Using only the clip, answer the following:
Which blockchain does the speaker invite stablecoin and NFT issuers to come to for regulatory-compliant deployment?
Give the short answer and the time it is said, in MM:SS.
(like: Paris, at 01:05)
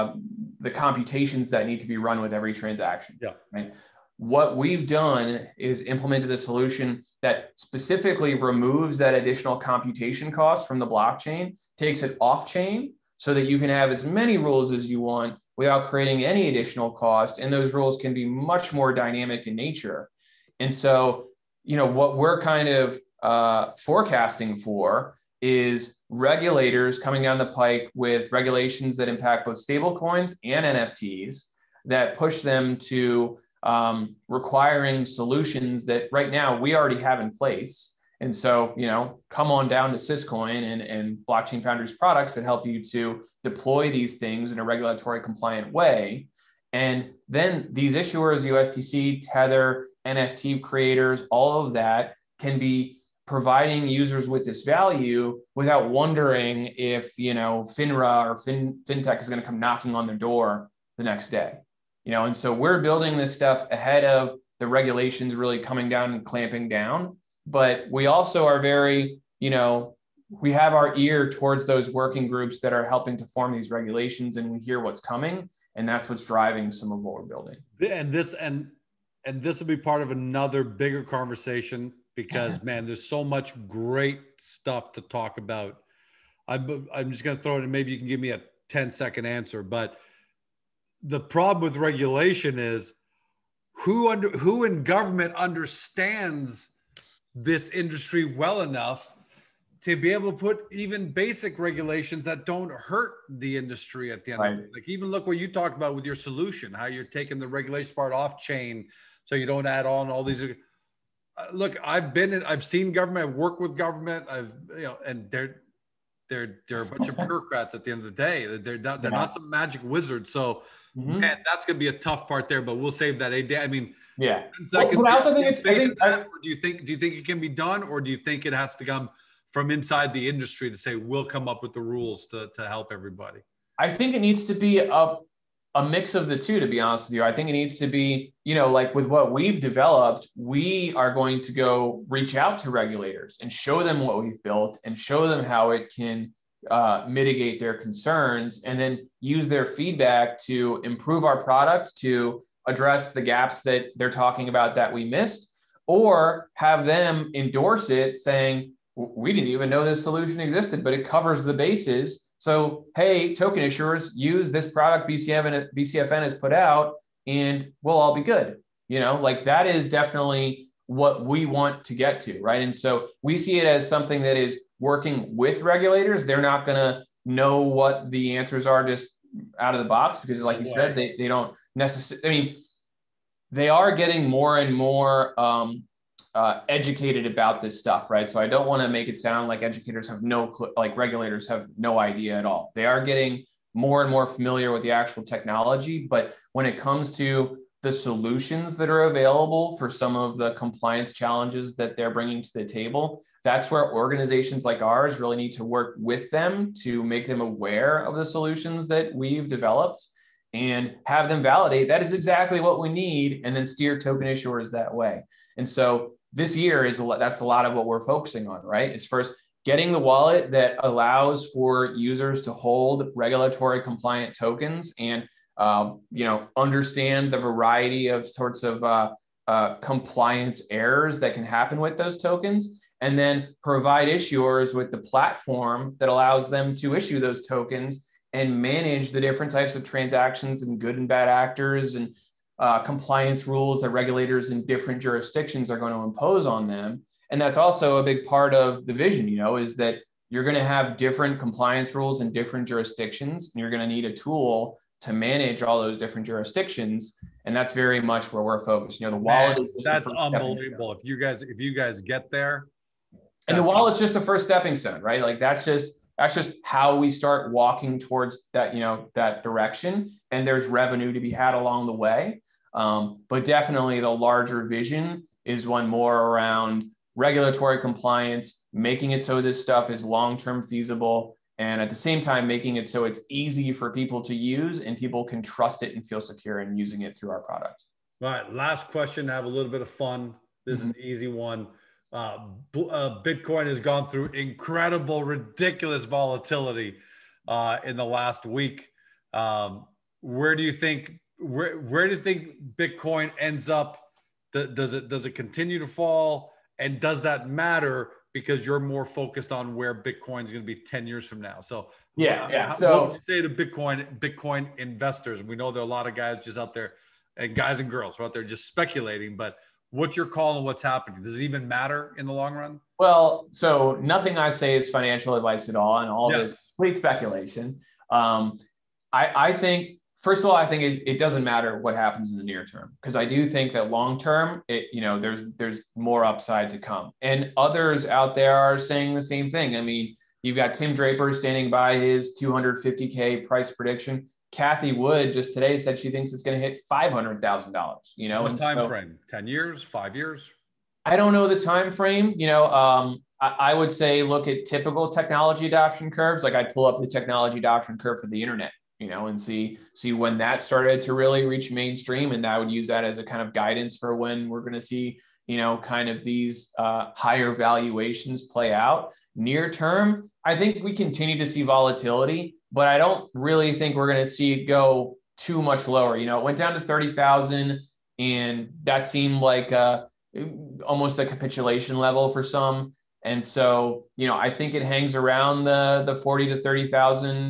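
Syscoin, at 00:39.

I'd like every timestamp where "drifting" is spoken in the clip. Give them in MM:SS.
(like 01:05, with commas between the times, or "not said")
not said.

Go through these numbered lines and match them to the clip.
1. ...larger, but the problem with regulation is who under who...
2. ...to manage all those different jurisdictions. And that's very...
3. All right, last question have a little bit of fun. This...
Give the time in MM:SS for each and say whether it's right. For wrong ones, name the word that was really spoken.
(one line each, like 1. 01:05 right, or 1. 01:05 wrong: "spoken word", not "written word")
1. 01:29 wrong: "answer", not "larger"
2. 04:14 right
3. 04:48 right.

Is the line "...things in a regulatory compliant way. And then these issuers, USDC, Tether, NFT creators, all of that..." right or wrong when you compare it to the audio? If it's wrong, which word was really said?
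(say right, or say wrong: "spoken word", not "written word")
right.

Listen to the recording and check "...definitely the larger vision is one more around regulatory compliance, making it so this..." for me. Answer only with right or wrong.
right.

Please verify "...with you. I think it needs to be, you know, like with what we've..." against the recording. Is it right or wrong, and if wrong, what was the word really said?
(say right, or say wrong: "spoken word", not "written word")
right.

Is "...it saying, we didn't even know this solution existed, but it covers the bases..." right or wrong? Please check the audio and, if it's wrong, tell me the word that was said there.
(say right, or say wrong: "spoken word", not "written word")
right.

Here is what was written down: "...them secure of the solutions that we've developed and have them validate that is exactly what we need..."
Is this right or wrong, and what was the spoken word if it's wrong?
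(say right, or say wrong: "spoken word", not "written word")
wrong: "aware", not "secure".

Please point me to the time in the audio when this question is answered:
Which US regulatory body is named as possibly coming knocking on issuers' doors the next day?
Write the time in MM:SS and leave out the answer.
00:57.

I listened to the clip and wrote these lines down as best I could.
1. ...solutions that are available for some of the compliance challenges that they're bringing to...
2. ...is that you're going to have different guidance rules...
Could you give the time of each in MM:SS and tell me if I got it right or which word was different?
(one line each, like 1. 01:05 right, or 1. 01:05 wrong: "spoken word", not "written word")
1. 03:17 right
2. 04:09 wrong: "compliance", not "guidance".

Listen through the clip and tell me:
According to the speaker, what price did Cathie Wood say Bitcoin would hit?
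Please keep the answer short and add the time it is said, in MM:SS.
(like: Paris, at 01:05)
$500,000, at 05:46.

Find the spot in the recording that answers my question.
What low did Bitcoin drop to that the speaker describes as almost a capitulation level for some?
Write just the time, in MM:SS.
06:16.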